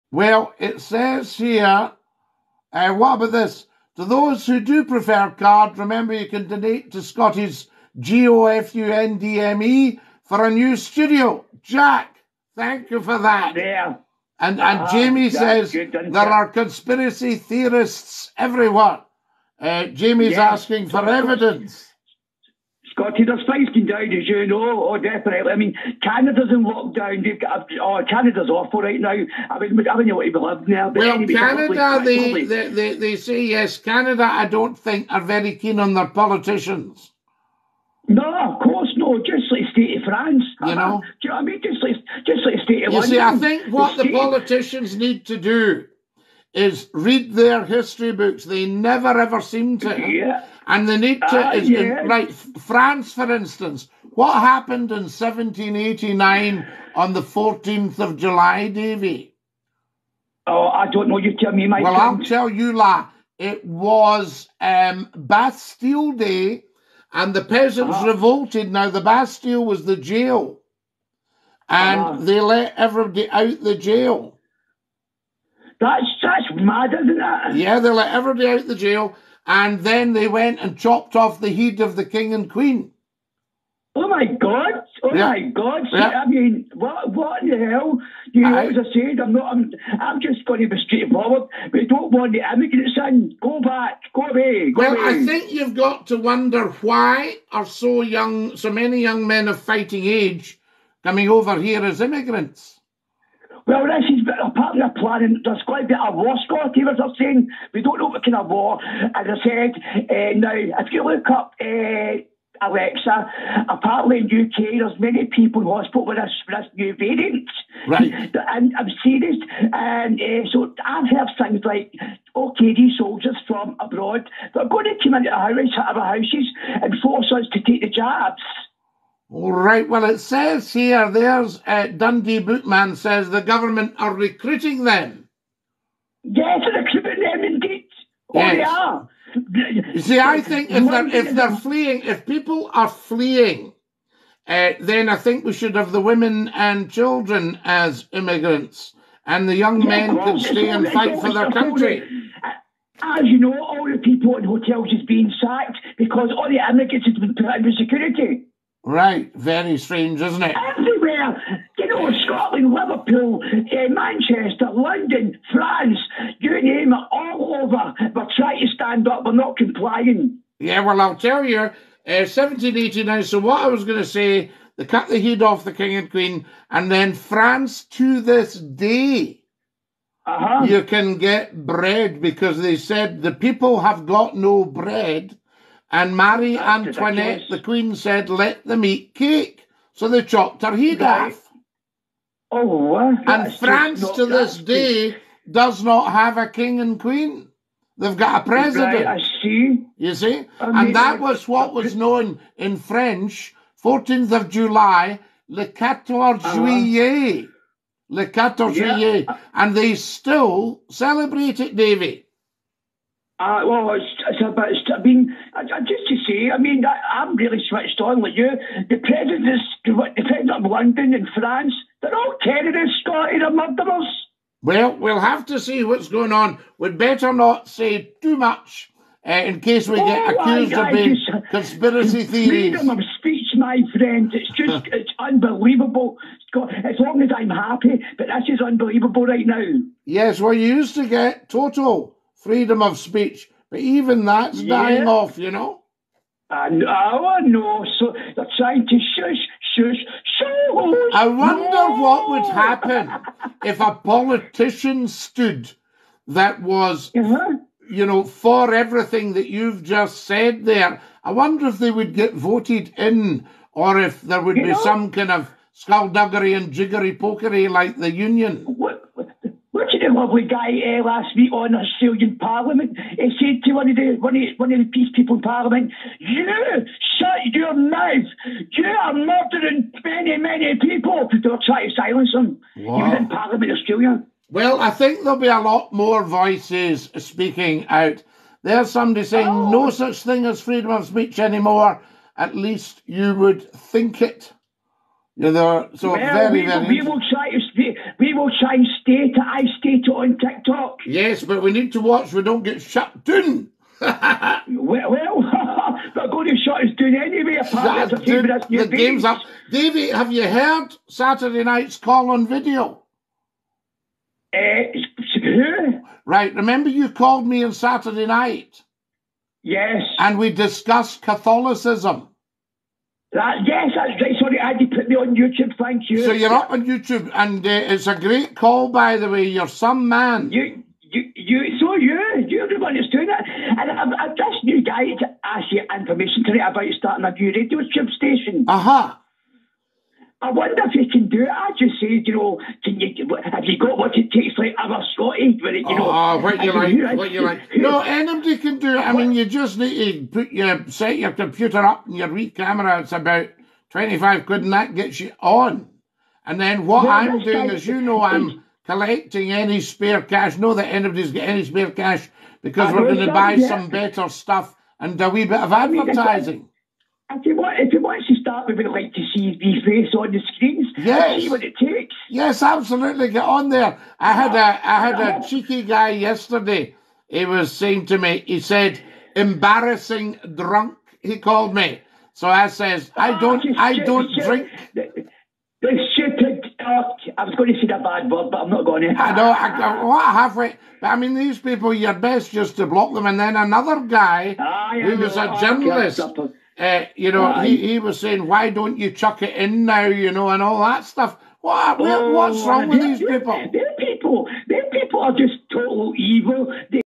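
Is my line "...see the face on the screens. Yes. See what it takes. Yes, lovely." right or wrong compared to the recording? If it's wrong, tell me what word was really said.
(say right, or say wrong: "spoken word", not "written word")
wrong: "absolutely", not "lovely".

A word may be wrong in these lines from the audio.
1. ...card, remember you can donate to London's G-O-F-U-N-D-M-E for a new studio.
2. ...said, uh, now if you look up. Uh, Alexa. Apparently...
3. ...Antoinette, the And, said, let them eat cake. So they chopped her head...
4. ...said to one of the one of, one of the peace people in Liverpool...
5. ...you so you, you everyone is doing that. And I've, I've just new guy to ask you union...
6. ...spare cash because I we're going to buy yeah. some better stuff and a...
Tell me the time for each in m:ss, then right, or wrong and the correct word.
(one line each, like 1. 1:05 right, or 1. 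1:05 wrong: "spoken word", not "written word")
1. 0:05 wrong: "Scottie", not "London"
2. 1:49 right
3. 3:06 wrong: "Queen", not "And"
4. 4:33 wrong: "Parliament", not "Liverpool"
5. 5:31 wrong: "information", not "union"
6. 6:01 right.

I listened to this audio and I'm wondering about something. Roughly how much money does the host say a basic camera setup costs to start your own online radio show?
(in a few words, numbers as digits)
about 25 quid.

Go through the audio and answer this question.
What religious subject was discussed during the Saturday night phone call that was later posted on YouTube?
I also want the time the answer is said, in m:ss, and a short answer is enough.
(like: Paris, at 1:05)
Catholicism, at 5:21.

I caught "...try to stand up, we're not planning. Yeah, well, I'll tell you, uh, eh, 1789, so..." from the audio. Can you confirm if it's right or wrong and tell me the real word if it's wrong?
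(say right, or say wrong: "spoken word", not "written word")
wrong: "complying", not "planning".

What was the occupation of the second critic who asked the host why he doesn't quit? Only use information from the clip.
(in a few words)
journalist.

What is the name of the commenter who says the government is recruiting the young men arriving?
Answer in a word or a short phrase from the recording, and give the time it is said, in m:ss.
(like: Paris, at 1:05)
Dundee Bootman, at 2:11.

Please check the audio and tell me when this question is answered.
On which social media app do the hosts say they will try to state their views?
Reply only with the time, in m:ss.
5:00.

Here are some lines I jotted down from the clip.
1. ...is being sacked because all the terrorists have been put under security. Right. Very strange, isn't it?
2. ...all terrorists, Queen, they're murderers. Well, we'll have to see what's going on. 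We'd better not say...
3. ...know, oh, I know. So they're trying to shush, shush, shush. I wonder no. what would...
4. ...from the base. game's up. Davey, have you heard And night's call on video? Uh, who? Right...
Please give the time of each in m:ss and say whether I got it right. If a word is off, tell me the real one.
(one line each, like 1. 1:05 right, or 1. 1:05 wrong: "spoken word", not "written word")
1. 2:34 wrong: "immigrants", not "terrorists"
2. 3:42 wrong: "Scottie", not "Queen"
3. 4:06 right
4. 5:08 wrong: "Saturday", not "And".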